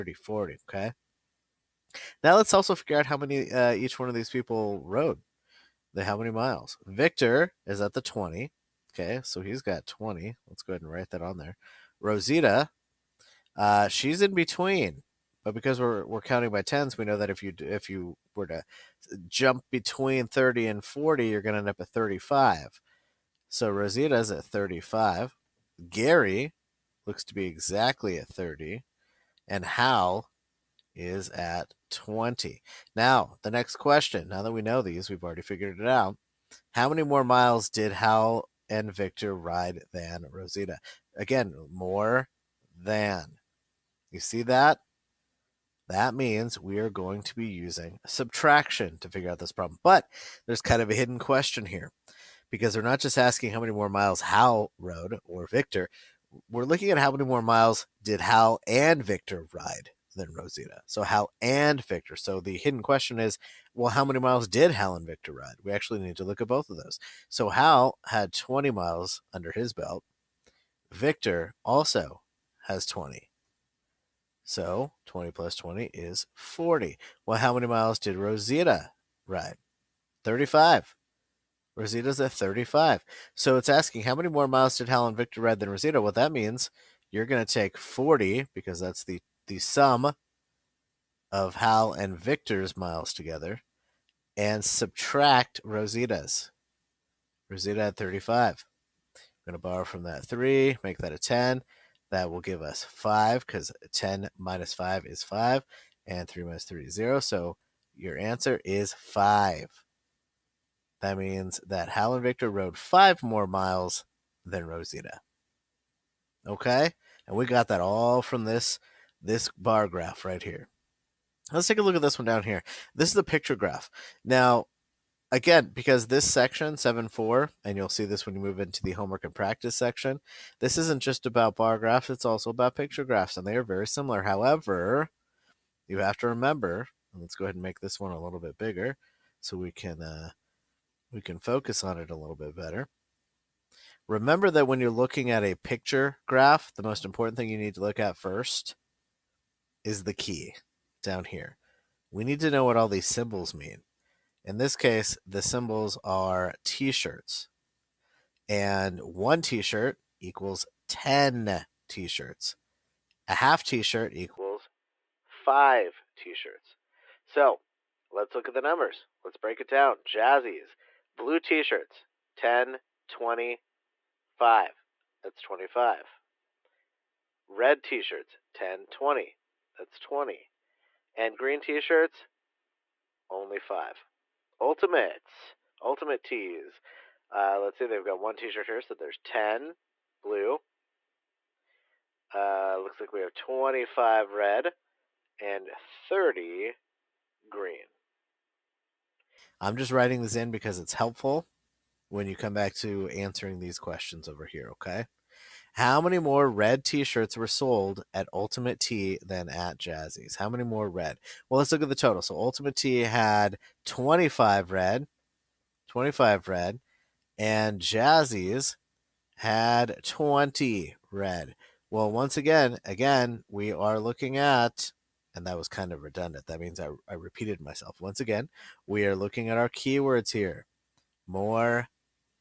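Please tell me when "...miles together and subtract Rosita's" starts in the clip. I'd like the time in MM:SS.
01:32.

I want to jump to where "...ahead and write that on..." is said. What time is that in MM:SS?
00:10.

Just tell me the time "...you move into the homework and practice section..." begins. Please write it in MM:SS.
02:08.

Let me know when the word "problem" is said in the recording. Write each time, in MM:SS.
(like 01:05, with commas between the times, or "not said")
00:49.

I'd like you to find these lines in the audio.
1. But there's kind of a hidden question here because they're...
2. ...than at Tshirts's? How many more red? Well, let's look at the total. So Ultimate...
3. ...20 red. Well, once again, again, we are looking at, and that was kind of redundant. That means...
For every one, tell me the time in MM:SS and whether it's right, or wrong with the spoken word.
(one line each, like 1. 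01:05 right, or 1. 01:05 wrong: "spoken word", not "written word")
1. 00:49 right
2. 03:29 wrong: "Jazzy", not "Tshirts"
3. 03:40 right.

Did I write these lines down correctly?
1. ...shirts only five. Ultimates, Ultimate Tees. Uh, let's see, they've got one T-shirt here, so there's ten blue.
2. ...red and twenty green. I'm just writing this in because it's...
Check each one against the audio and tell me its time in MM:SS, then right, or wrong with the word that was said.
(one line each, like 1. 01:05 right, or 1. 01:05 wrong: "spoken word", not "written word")
1. 03:01 right
2. 03:14 wrong: "thirty", not "twenty".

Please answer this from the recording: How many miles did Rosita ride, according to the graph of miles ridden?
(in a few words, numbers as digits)
35.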